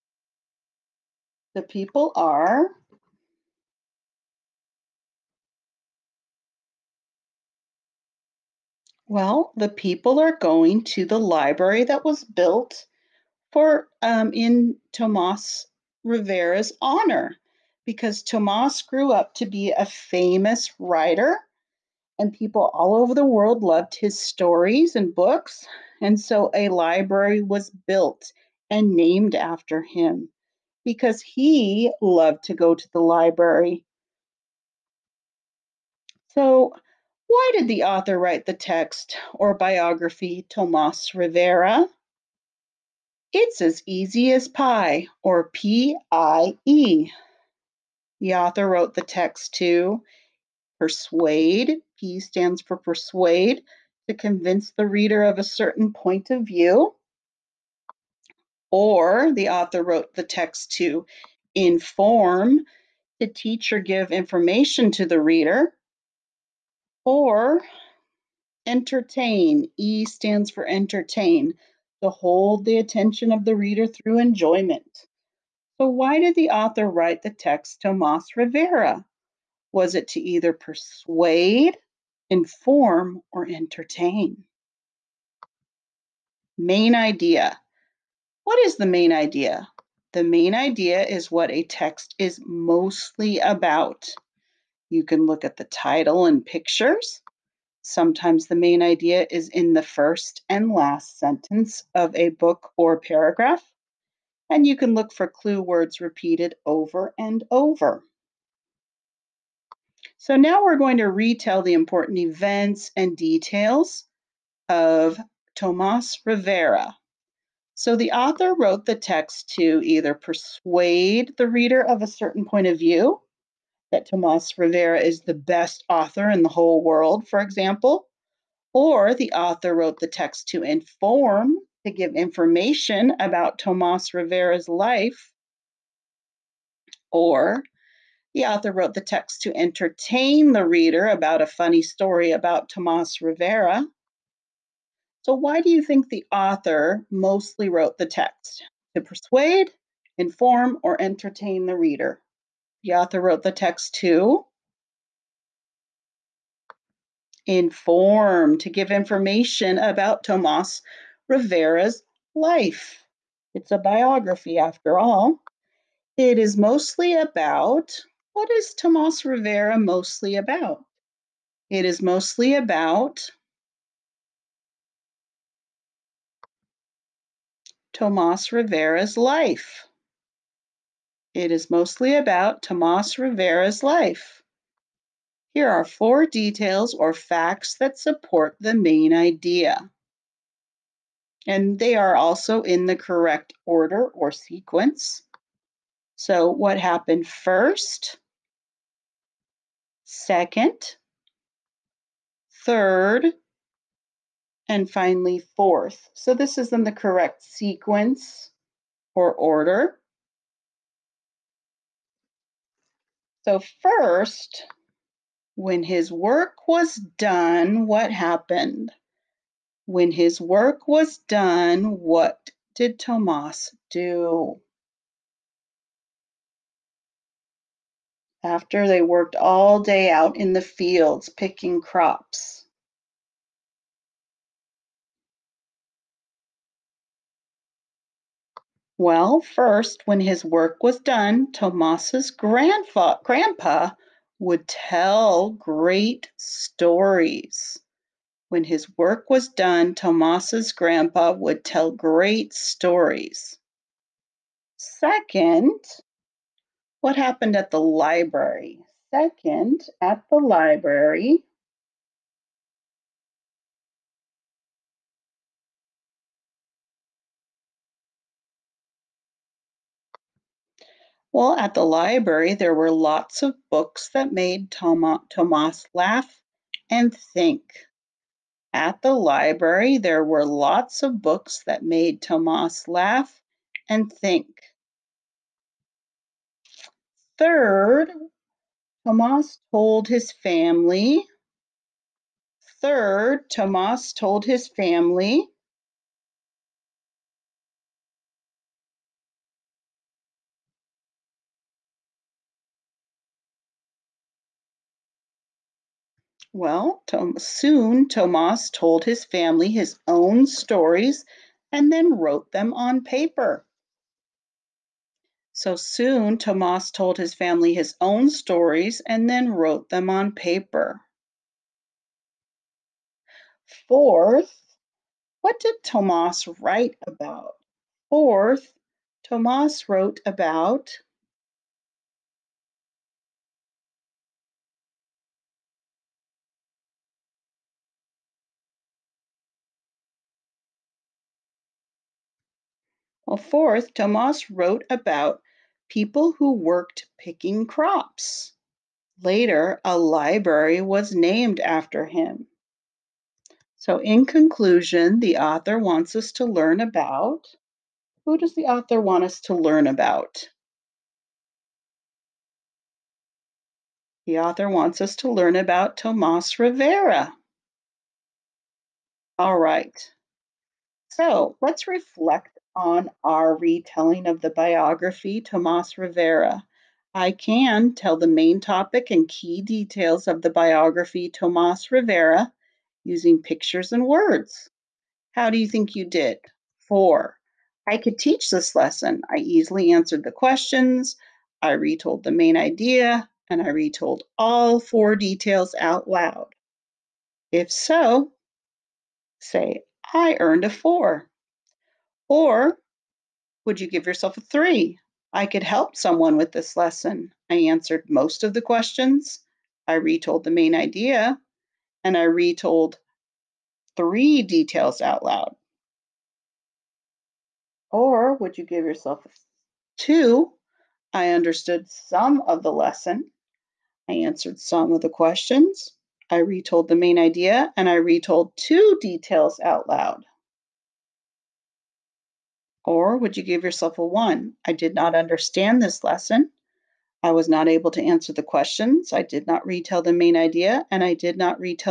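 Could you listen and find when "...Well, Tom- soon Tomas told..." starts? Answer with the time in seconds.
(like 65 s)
306 s.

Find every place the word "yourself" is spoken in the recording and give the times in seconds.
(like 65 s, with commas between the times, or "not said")
404 s, 418 s, 433 s.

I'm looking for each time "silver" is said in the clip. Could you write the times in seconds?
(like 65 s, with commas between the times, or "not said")
not said.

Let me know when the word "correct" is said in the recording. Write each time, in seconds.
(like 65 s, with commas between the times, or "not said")
192 s, 206 s.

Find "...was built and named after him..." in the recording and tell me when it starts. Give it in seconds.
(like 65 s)
27 s.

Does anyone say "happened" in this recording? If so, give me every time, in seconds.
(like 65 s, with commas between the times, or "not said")
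196 s, 218 s, 257 s.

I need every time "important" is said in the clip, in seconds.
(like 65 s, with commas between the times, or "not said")
111 s.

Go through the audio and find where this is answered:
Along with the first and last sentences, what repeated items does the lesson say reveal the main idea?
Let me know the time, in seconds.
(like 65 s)
105 s.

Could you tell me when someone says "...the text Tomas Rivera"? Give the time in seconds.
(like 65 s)
77 s.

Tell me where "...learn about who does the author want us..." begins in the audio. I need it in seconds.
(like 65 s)
356 s.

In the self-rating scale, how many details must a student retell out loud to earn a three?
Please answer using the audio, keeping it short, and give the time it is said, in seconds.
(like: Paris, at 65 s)
3, at 413 s.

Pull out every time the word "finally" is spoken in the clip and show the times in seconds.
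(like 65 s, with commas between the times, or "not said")
204 s.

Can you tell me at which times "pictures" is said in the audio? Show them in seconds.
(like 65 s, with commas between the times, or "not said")
96 s, 383 s.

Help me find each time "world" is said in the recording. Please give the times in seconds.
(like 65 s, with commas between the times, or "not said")
23 s, 126 s.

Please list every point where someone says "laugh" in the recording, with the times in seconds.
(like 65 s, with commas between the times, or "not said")
275 s, 282 s.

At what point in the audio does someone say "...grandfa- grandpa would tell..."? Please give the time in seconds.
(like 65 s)
242 s.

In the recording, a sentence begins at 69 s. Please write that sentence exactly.
E stands for entertain, to hold the attention of the reader through enjoyment.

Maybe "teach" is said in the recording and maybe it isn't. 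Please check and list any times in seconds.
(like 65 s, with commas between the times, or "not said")
63 s, 388 s.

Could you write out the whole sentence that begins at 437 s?
I was not able to answer the questions.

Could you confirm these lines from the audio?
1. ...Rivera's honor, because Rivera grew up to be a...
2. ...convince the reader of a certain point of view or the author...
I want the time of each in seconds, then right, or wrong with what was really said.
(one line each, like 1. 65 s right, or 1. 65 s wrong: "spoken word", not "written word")
1. 16 s wrong: "Tomas", not "Rivera"
2. 54 s right.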